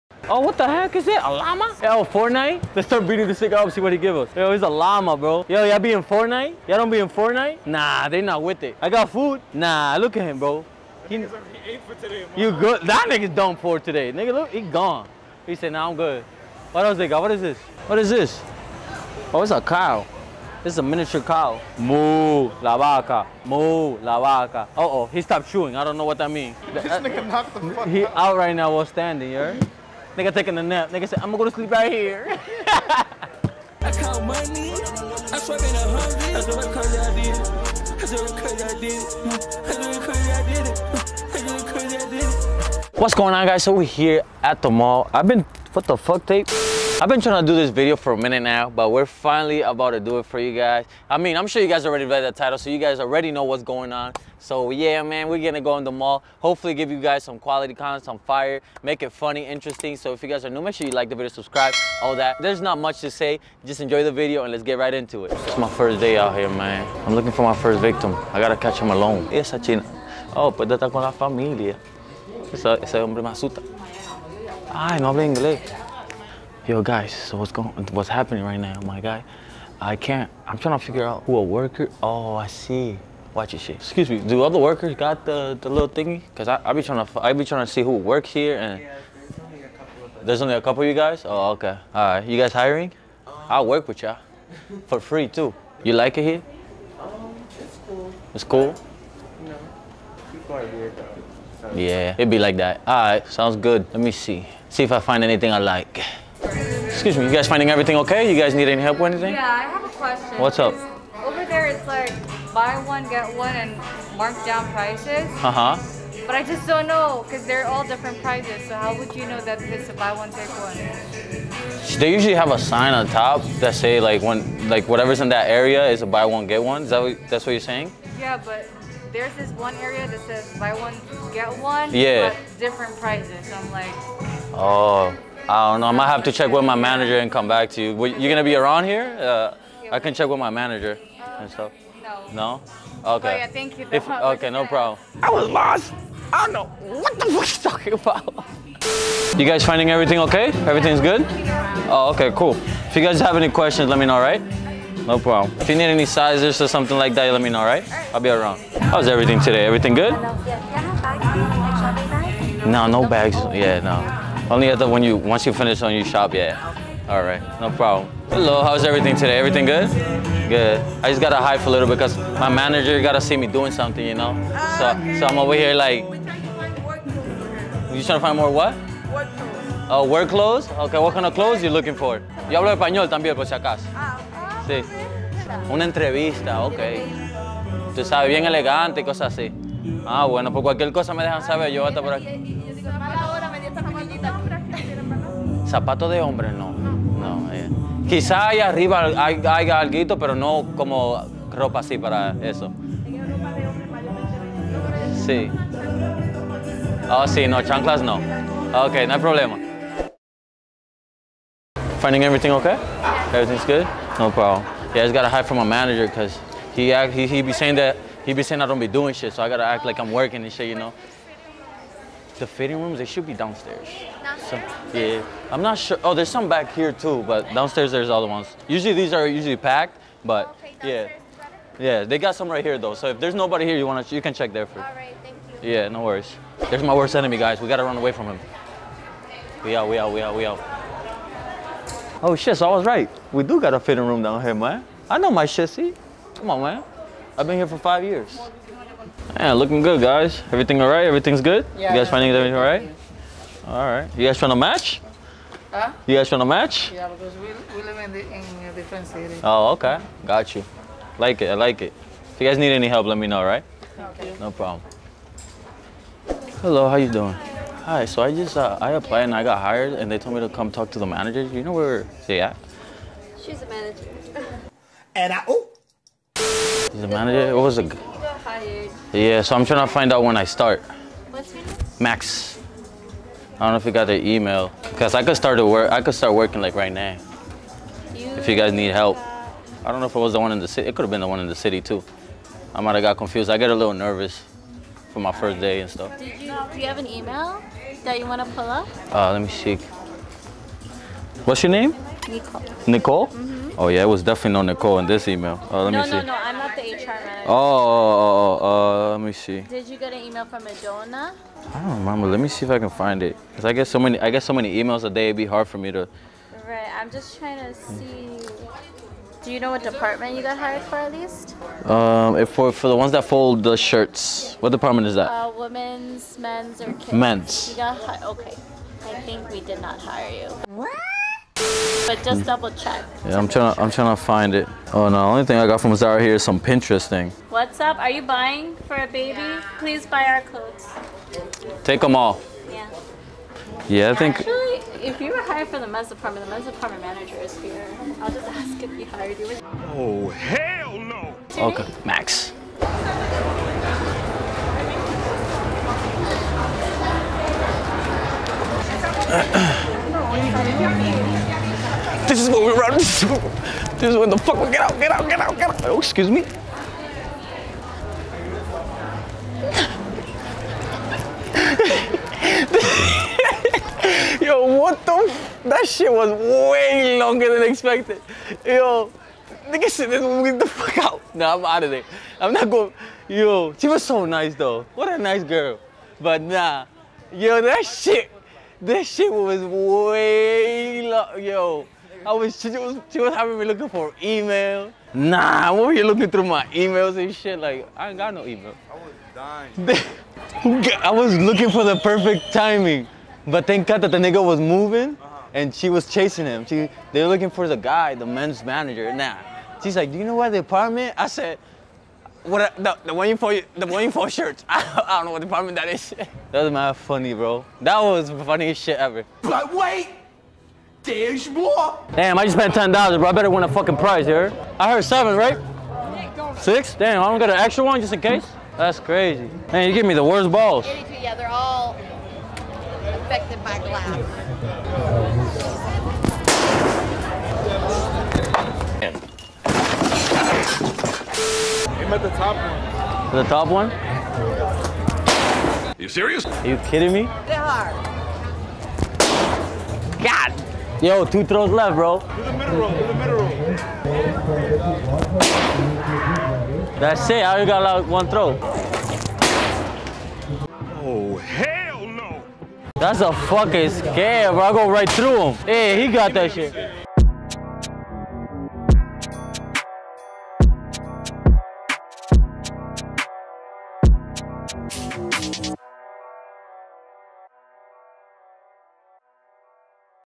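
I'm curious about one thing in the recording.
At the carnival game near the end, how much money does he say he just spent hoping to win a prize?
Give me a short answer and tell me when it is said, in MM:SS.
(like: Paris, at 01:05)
$10, at 07:02.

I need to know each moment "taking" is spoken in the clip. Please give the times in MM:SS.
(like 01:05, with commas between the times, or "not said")
00:30.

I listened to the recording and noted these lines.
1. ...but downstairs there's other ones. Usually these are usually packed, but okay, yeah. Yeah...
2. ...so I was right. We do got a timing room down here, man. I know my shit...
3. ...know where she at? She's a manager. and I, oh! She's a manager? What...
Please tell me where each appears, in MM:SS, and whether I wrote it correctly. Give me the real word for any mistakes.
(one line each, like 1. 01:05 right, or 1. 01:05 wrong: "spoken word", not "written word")
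1. 03:47 right
2. 04:02 wrong: "fitting", not "timing"
3. 04:31 right.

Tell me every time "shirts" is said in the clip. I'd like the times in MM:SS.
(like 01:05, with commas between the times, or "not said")
05:23, 06:54.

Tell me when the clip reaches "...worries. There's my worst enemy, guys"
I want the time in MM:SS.
03:56.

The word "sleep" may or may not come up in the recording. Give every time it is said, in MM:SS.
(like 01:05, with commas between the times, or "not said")
00:31.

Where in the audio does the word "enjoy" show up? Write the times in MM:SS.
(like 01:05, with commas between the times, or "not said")
01:03.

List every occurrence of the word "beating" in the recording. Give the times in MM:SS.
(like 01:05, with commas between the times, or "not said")
00:03.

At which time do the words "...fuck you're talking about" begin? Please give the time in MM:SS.
02:27.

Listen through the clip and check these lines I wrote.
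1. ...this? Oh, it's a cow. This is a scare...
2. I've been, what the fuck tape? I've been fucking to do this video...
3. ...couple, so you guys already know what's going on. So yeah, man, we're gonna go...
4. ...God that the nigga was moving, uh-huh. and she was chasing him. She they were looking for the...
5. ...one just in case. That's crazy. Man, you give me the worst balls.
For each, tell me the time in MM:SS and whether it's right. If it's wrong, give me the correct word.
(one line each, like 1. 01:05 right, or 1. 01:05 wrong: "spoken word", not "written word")
1. 00:18 wrong: "miniature", not "scare"
2. 00:45 wrong: "trying", not "fucking"
3. 00:52 wrong: "title", not "couple"
4. 06:43 right
5. 07:07 right.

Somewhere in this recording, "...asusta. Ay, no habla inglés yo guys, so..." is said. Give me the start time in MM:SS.
01:13.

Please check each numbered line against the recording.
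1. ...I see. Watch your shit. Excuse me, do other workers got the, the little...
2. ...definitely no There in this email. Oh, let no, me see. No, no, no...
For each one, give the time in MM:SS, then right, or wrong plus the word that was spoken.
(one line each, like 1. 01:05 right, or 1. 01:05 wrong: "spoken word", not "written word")
1. 01:22 right
2. 05:04 wrong: "Nicole", not "There".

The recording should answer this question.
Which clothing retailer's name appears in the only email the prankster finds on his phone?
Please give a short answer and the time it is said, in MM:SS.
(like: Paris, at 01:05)
Zara, at 05:35.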